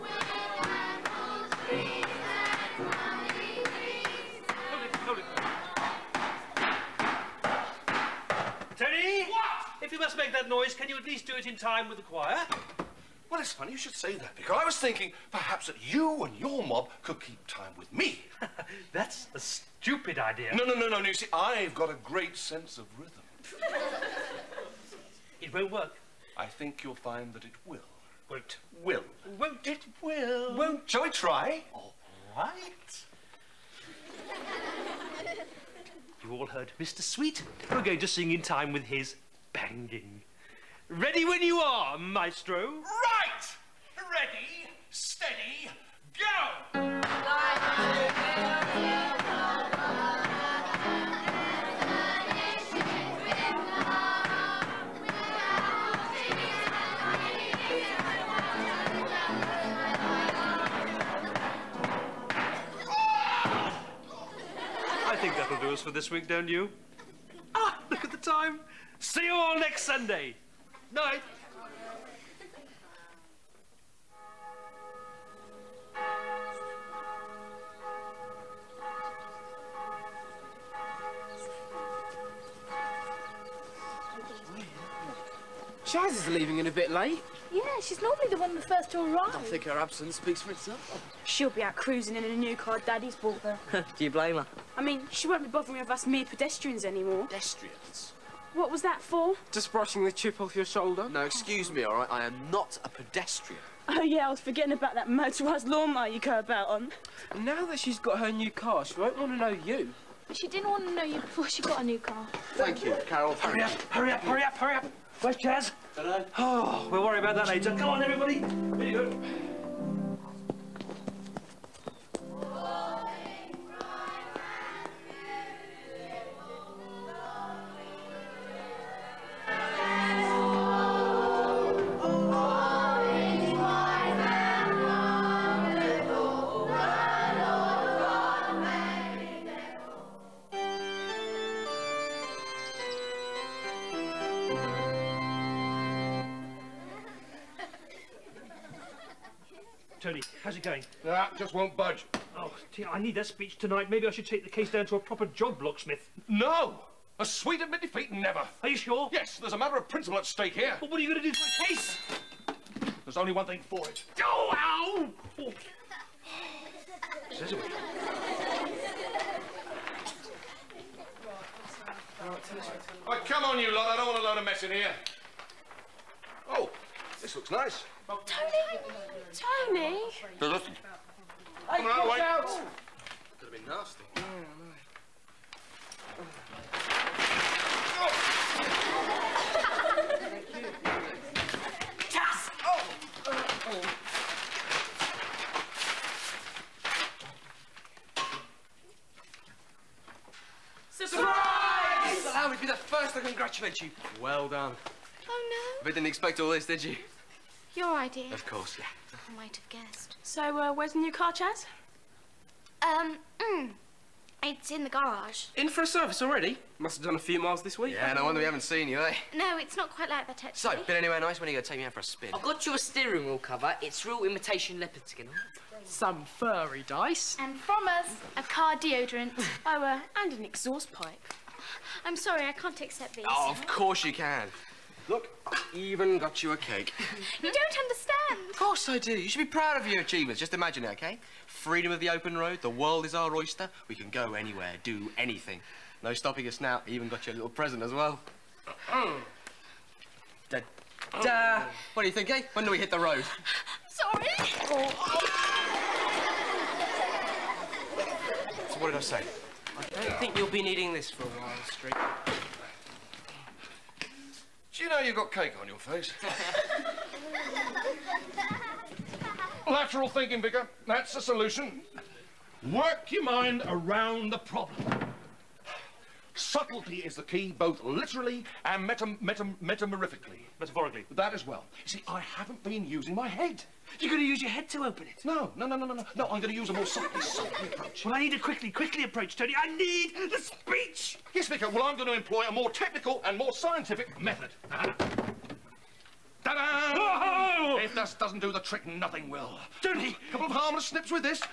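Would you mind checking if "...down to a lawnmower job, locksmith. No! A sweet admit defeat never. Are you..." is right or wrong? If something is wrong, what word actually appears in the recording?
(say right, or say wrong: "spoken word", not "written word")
wrong: "proper", not "lawnmower".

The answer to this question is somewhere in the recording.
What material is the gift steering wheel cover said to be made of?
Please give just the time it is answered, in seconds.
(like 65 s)
224 s.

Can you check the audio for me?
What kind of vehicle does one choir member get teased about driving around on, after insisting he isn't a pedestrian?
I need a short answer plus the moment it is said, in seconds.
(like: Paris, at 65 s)
motorised lawnmower, at 105 s.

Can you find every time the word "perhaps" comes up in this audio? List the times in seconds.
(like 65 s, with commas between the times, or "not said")
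15 s.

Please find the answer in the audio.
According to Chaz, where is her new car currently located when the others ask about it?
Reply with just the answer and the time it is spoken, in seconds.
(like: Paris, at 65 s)
in the garage, at 214 s.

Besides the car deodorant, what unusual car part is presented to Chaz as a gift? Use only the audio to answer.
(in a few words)
an exhaust pipe.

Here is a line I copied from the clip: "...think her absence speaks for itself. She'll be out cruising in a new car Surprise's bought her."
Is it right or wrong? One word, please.
wrong.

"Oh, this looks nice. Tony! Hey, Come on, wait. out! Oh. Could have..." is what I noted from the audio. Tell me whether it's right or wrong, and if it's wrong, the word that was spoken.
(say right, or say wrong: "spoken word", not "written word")
right.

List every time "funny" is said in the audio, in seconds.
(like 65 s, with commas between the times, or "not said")
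13 s.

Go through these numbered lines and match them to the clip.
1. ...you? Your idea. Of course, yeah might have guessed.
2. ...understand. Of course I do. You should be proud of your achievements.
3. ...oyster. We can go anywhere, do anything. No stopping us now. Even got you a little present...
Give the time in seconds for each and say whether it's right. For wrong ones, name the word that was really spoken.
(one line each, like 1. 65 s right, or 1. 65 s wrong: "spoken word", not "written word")
1. 206 s right
2. 237 s right
3. 243 s right.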